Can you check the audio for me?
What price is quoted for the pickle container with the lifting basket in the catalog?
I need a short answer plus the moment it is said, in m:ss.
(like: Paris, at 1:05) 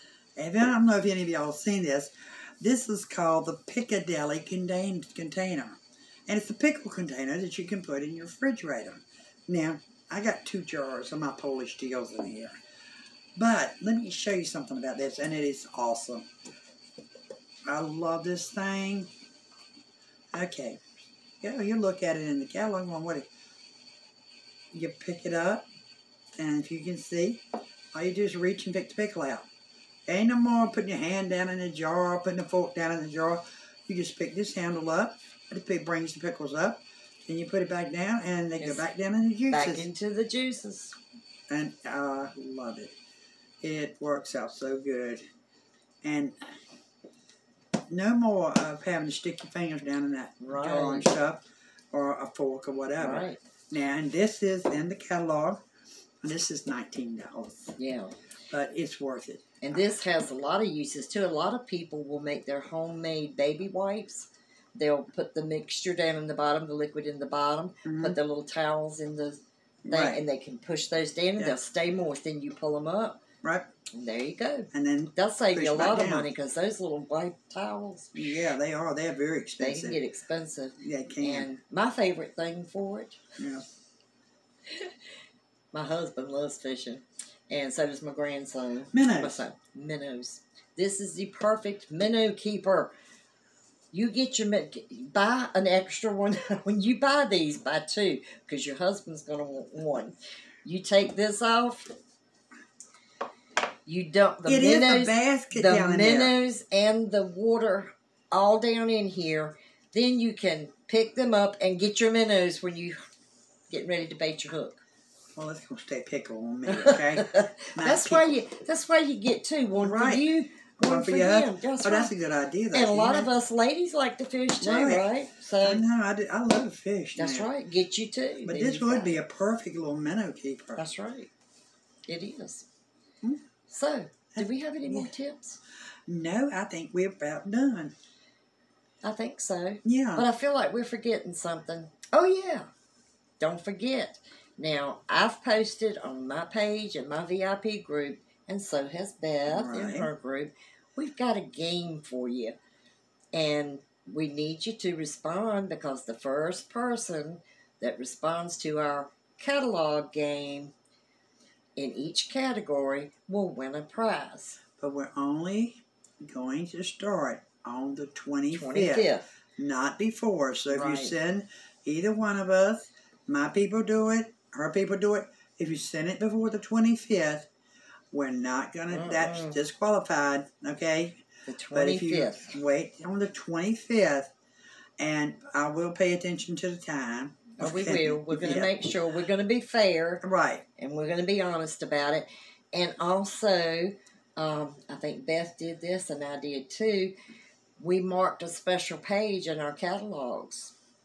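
$19, at 0:56.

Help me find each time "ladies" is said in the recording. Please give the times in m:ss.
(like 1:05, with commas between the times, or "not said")
2:03.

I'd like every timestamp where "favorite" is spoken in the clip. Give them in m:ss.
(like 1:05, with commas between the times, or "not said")
1:21.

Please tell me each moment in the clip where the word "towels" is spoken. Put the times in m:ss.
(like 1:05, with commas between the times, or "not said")
1:08, 1:17.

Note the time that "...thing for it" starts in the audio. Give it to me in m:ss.
1:22.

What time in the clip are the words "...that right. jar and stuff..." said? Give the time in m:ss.
0:50.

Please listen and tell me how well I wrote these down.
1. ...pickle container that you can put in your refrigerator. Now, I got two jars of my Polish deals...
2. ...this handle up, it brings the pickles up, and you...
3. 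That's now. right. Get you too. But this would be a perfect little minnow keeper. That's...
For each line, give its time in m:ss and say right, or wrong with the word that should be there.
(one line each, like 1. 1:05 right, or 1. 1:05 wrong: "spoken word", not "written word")
1. 0:06 right
2. 0:34 right
3. 2:07 right.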